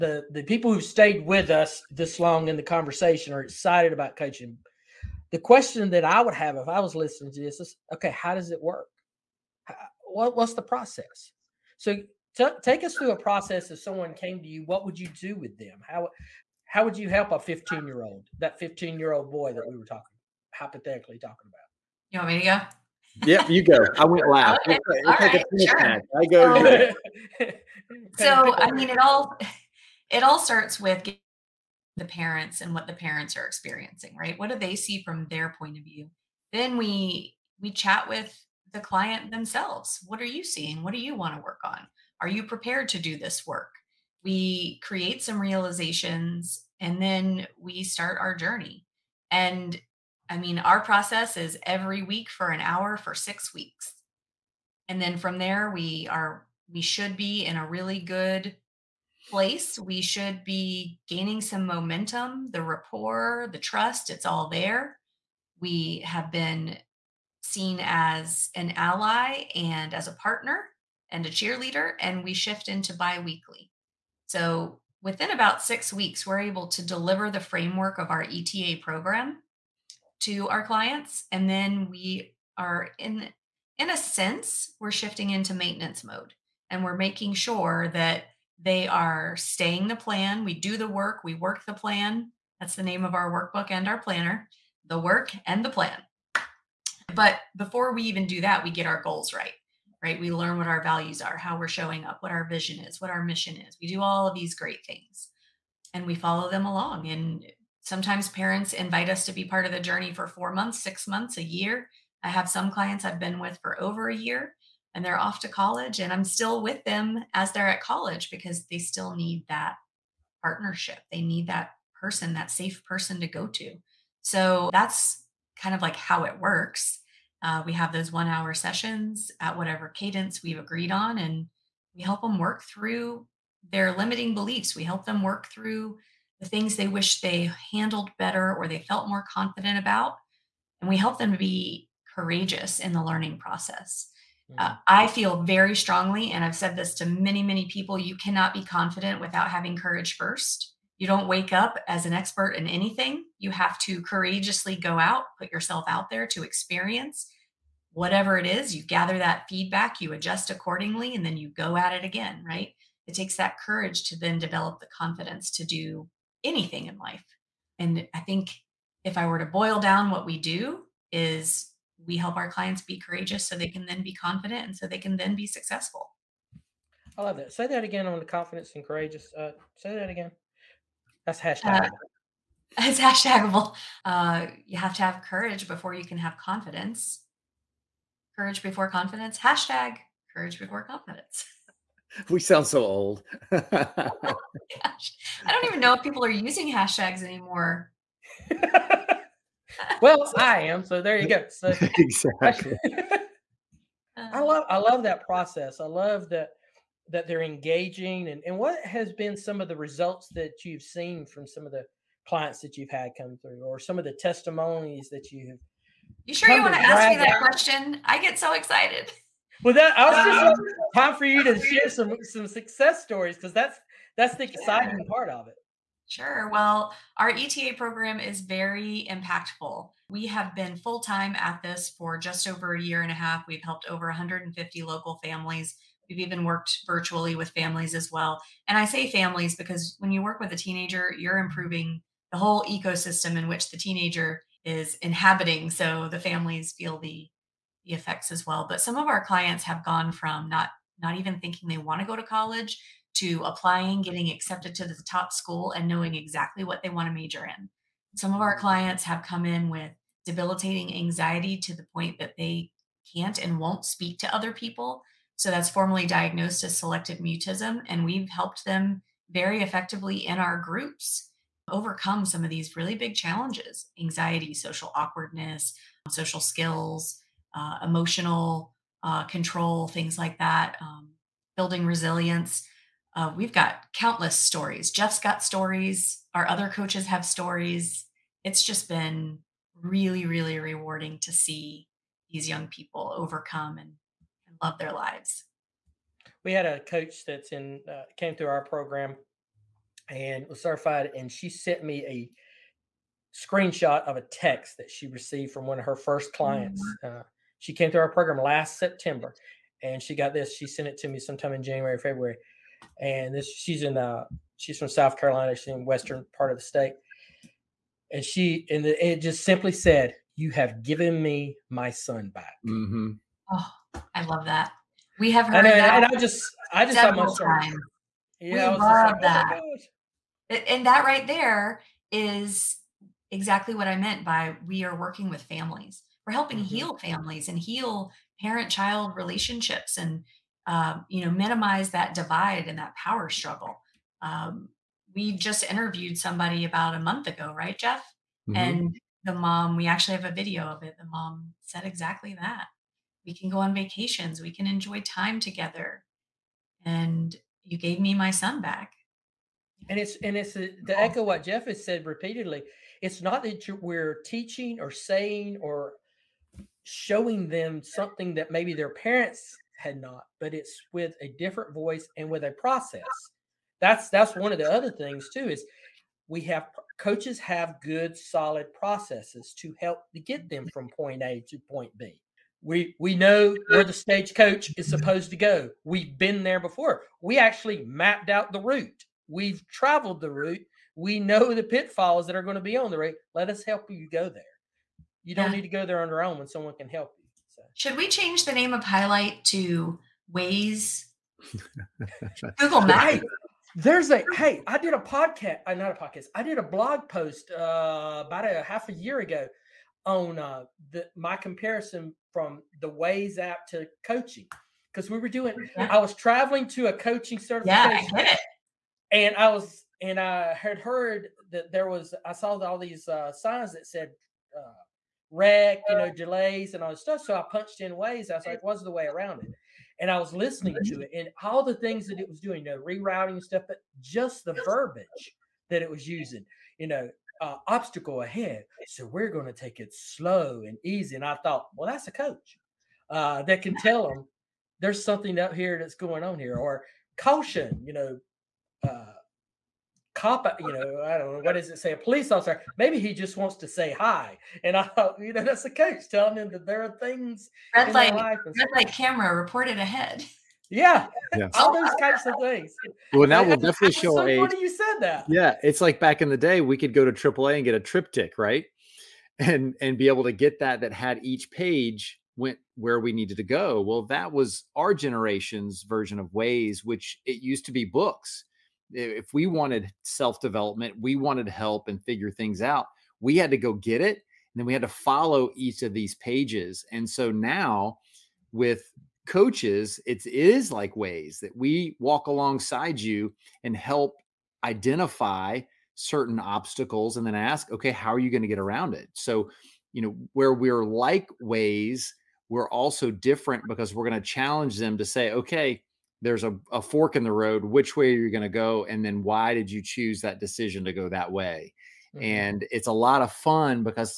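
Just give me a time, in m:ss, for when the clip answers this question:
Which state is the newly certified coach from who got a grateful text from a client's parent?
5:14.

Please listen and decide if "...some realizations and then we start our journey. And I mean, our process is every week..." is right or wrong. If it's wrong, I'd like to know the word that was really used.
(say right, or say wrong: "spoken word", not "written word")
right.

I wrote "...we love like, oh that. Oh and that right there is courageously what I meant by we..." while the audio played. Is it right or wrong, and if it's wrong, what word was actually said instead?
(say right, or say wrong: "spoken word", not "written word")
wrong: "exactly", not "courageously".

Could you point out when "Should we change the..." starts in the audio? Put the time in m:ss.
6:37.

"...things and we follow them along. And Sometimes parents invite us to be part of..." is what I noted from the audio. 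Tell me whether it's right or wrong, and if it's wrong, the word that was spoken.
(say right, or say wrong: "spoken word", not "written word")
right.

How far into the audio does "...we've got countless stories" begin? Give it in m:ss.
4:43.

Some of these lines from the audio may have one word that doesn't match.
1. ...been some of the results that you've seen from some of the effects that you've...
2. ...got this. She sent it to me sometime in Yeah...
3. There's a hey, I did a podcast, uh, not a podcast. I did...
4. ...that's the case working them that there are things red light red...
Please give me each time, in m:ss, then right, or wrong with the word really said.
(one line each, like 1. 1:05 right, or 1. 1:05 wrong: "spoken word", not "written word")
1. 3:29 wrong: "clients", not "effects"
2. 5:10 wrong: "January", not "Yeah"
3. 6:43 right
4. 7:35 wrong: "telling", not "working".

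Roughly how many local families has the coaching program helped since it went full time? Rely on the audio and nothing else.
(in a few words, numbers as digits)
150.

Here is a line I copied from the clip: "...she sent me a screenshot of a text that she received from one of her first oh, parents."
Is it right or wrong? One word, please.
wrong.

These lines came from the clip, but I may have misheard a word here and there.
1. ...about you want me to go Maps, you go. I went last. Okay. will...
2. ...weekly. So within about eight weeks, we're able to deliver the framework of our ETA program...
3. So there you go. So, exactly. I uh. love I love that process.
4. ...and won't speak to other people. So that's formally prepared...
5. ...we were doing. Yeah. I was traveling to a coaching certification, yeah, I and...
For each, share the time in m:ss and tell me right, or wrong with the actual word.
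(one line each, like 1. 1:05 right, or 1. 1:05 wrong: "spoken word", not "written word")
1. 0:21 wrong: "Yep", not "Maps"
2. 1:13 wrong: "six", not "eight"
3. 3:20 right
4. 4:23 wrong: "diagnosed", not "prepared"
5. 6:55 right.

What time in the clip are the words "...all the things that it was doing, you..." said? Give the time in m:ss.
7:11.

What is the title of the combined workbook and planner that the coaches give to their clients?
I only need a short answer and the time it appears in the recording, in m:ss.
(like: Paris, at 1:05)
The Work and the Plan, at 1:34.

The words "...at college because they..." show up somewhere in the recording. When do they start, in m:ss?
1:57.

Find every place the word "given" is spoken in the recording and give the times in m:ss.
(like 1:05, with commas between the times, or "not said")
5:20.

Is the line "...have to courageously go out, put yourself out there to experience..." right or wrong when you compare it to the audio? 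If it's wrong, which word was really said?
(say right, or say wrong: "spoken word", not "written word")
right.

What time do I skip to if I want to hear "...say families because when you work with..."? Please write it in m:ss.
3:58.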